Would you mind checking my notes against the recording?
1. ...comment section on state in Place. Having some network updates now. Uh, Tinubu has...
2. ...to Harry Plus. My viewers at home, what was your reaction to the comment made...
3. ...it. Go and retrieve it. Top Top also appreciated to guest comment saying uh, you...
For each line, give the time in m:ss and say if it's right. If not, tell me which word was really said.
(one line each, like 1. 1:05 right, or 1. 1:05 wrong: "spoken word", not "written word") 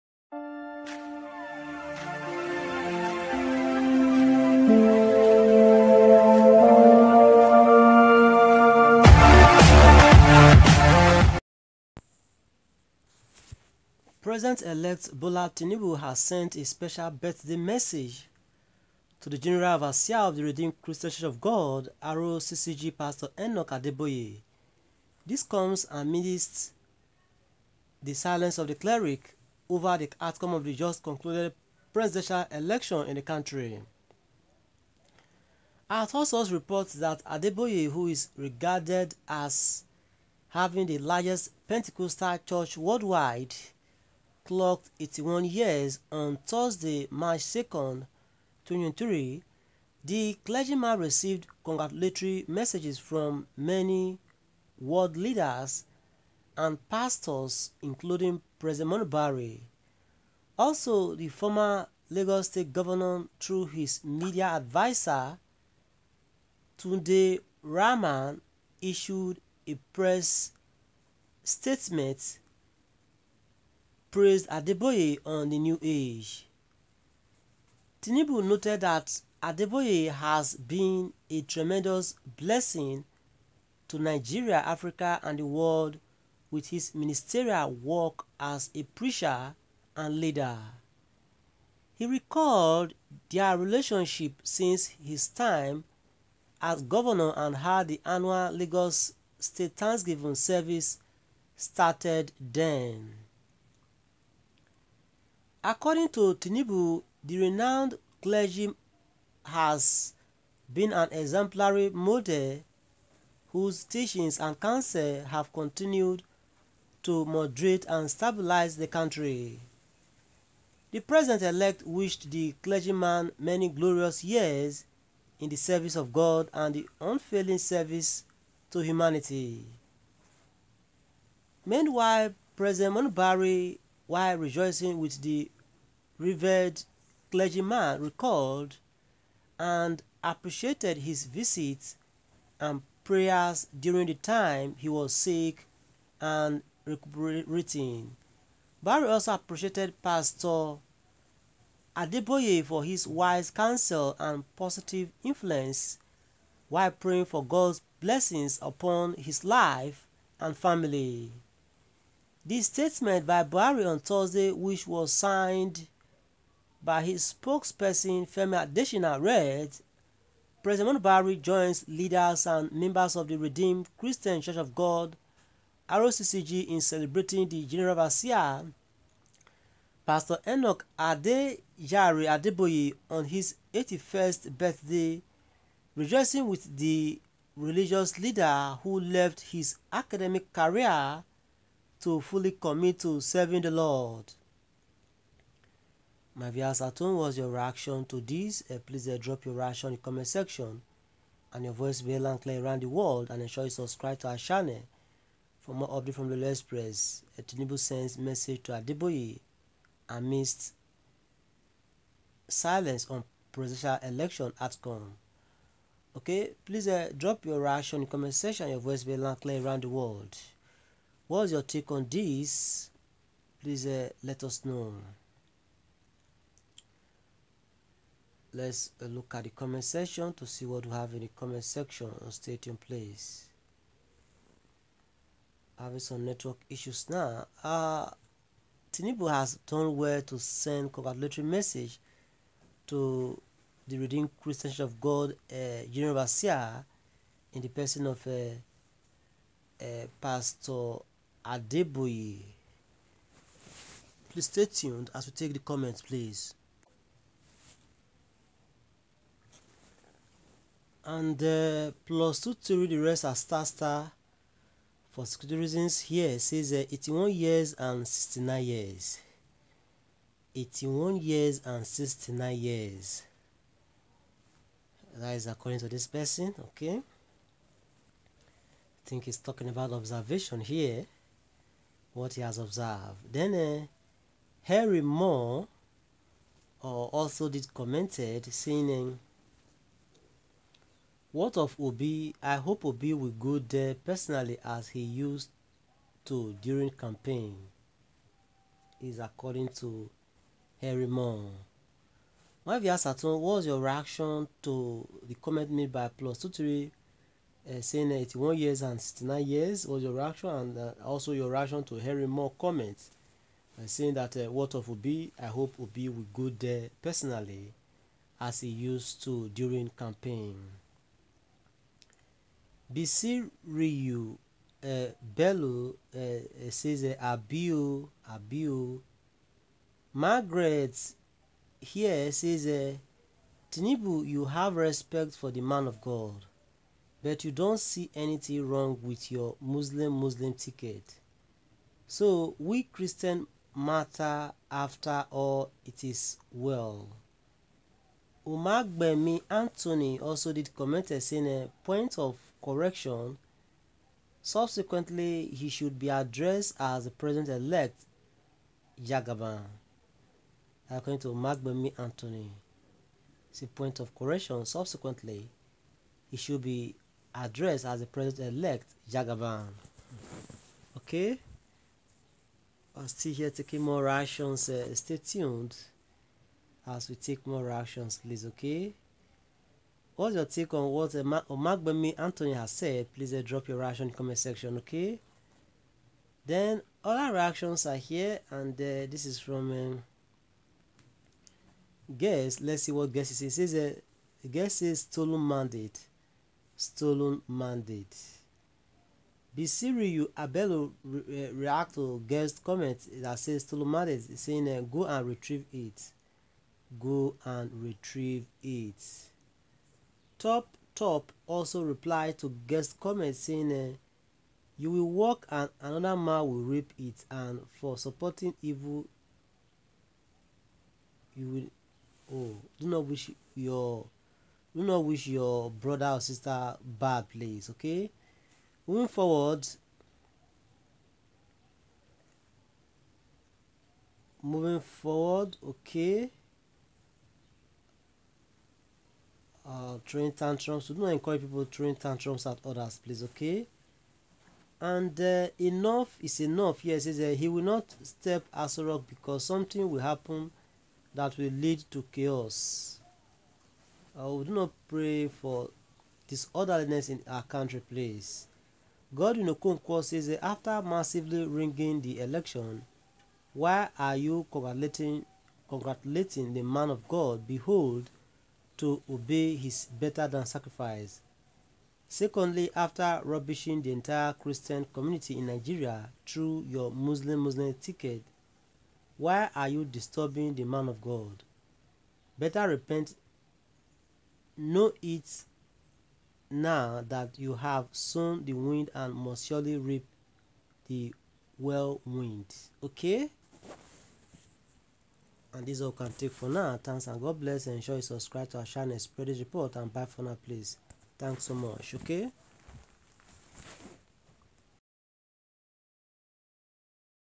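1. 3:51 wrong: "issues", not "updates"
2. 4:59 wrong: "Moore", not "Plus"
3. 6:45 wrong: "replied", not "appreciated".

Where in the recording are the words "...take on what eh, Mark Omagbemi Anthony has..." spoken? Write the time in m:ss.
6:20.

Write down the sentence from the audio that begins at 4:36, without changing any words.
I think he's talking about observation here.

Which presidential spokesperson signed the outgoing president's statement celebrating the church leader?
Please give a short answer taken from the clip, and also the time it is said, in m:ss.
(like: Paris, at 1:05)
Femi Adesina, at 2:48.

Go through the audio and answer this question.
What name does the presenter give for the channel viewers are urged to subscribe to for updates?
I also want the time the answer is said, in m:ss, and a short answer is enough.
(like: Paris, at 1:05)
Lord's Press, at 3:26.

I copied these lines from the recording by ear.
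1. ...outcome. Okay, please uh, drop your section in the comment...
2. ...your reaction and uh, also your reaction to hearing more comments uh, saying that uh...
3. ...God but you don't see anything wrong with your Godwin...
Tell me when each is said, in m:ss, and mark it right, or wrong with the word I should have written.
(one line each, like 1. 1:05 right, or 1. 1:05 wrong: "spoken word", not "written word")
1. 3:34 wrong: "reaction", not "section"
2. 5:10 right
3. 5:36 wrong: "Muslim", not "Godwin".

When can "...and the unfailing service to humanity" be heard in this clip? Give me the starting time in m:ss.
2:06.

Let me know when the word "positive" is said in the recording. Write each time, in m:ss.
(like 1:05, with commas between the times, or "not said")
2:34.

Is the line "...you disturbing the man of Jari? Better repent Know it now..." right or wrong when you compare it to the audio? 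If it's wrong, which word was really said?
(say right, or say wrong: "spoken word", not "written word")
wrong: "God", not "Jari".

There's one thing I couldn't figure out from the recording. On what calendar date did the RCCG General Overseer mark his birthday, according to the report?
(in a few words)
March 2, 2023.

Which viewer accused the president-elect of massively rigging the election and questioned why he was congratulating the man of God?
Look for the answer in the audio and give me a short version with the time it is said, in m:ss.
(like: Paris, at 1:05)
Godwin Okonkwo, at 7:39.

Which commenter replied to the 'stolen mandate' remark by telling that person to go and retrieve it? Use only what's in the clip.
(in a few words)
Bisiriyu Abelo.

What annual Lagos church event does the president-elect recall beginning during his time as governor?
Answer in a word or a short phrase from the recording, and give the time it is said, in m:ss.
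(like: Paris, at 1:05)
Lagos State Thanksgiving service, at 1:38.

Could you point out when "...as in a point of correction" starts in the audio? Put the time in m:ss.
5:51.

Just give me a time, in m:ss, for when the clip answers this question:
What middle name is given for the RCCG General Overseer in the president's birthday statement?
3:00.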